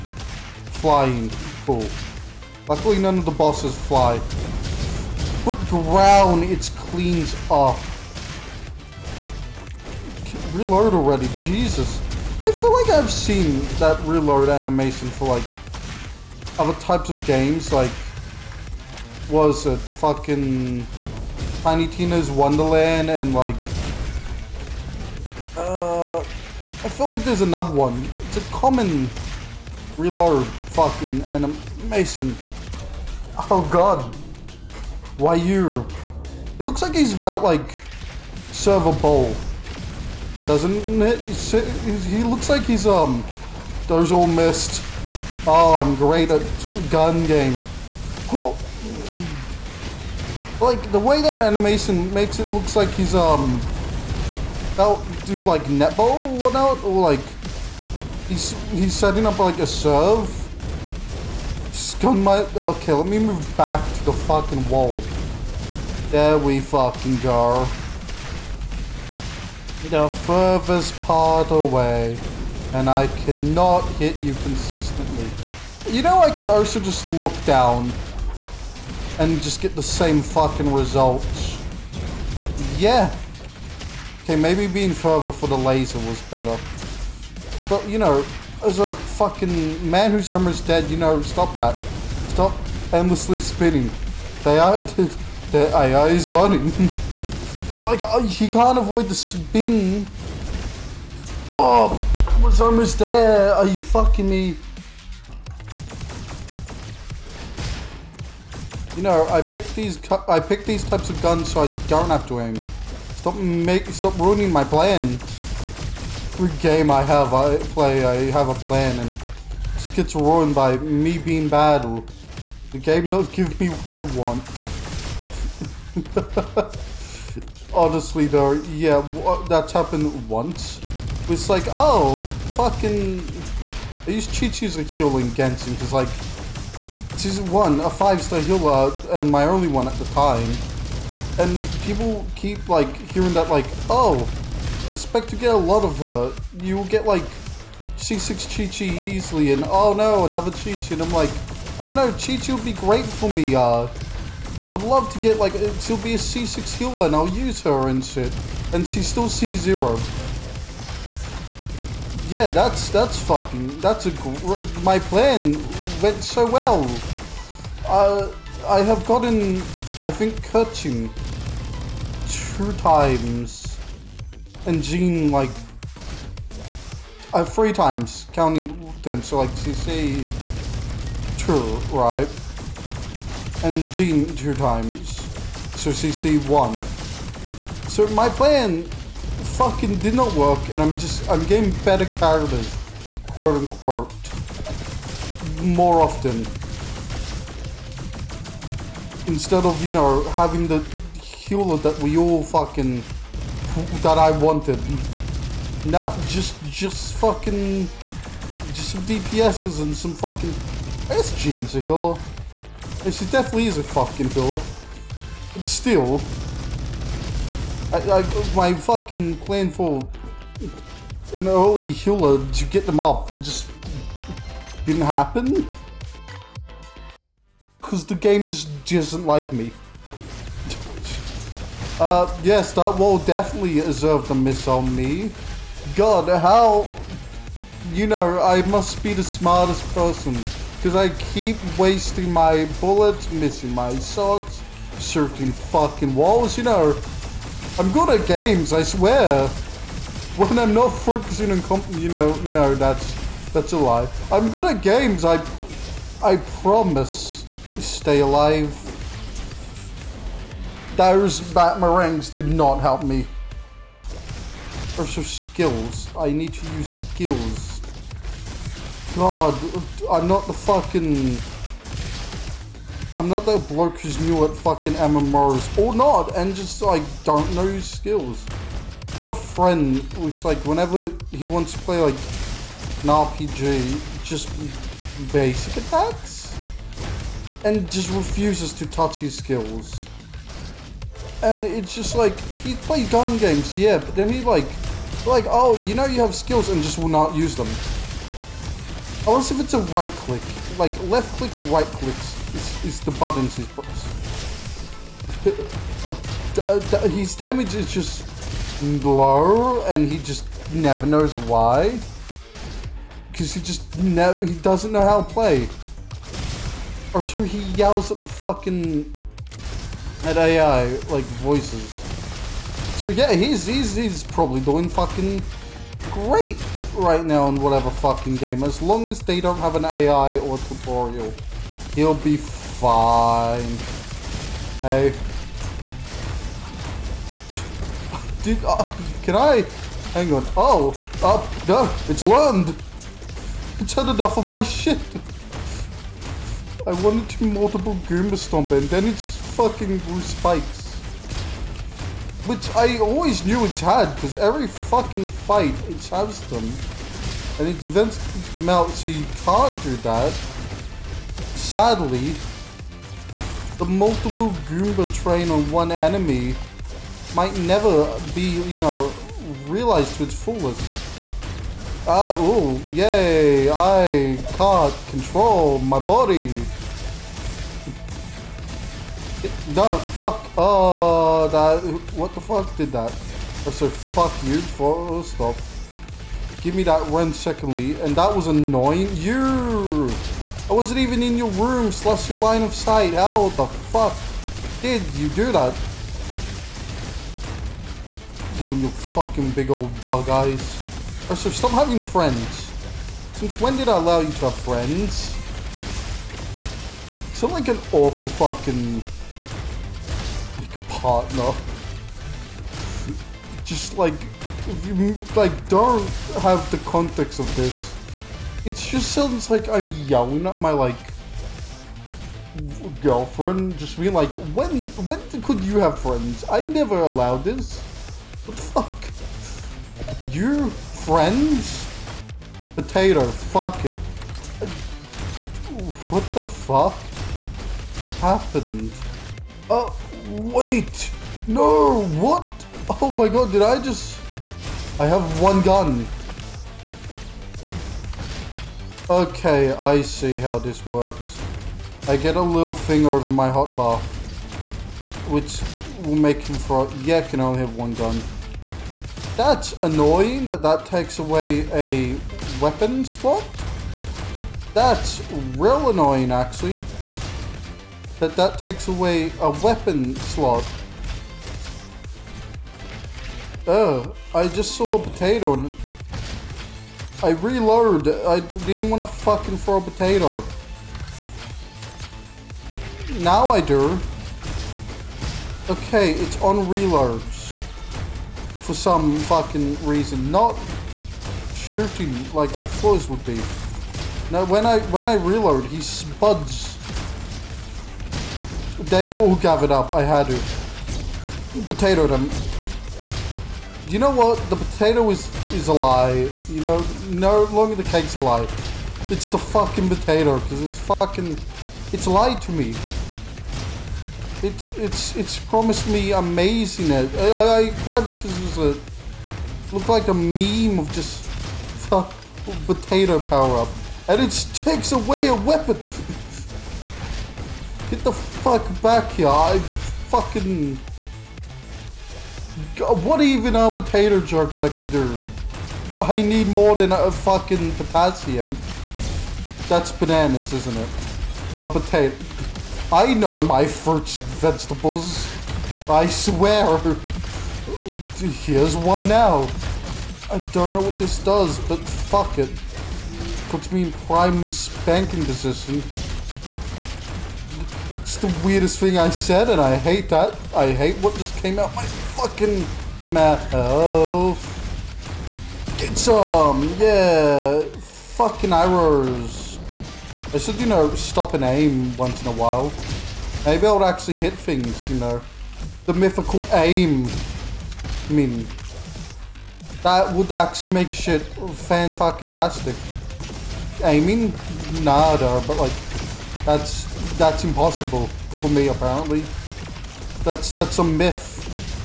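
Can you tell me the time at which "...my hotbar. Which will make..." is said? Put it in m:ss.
7:33.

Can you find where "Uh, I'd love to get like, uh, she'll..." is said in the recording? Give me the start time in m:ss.
2:33.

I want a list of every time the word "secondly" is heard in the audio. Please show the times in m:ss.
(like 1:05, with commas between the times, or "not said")
6:27.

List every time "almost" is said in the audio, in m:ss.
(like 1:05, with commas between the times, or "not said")
1:30, 1:42.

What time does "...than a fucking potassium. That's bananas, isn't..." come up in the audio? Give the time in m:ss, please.
8:56.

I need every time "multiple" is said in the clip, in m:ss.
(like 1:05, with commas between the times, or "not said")
5:47, 6:03.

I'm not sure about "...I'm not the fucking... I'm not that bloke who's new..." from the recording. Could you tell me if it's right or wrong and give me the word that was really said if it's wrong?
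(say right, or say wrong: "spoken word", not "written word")
right.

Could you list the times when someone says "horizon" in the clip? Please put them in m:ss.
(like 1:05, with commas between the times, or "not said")
not said.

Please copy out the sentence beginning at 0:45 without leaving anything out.
Oh, I'm great at gun game.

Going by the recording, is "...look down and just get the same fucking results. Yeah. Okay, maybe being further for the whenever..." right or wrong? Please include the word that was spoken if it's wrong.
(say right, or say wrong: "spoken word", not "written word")
wrong: "laser", not "whenever".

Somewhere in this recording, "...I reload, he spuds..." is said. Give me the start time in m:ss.
8:15.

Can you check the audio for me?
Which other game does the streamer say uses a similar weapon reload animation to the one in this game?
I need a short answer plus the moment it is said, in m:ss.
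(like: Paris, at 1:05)
Tiny Tina's Wonderland, at 0:21.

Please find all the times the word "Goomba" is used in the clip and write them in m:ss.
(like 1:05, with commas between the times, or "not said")
5:48, 6:04.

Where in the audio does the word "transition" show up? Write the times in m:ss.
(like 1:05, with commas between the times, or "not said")
not said.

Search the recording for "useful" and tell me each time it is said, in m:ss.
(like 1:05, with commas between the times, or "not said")
not said.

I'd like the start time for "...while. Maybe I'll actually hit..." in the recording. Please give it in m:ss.
9:32.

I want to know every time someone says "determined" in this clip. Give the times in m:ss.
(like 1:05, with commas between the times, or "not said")
not said.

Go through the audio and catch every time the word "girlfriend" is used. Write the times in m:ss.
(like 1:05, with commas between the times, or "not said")
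7:03.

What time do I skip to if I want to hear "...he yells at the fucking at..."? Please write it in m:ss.
5:17.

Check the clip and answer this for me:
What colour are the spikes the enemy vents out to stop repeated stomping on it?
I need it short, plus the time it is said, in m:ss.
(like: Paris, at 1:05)
Blue, at 5:50.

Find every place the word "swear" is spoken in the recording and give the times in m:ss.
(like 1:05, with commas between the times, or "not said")
4:08, 9:06.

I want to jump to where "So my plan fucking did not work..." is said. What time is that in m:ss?
3:07.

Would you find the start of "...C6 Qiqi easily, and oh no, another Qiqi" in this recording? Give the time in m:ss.
2:27.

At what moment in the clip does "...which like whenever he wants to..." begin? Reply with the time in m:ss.
4:40.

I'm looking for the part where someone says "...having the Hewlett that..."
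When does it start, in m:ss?
3:20.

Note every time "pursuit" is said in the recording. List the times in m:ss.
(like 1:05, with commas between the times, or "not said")
not said.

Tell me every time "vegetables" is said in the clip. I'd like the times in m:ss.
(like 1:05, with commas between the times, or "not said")
9:04.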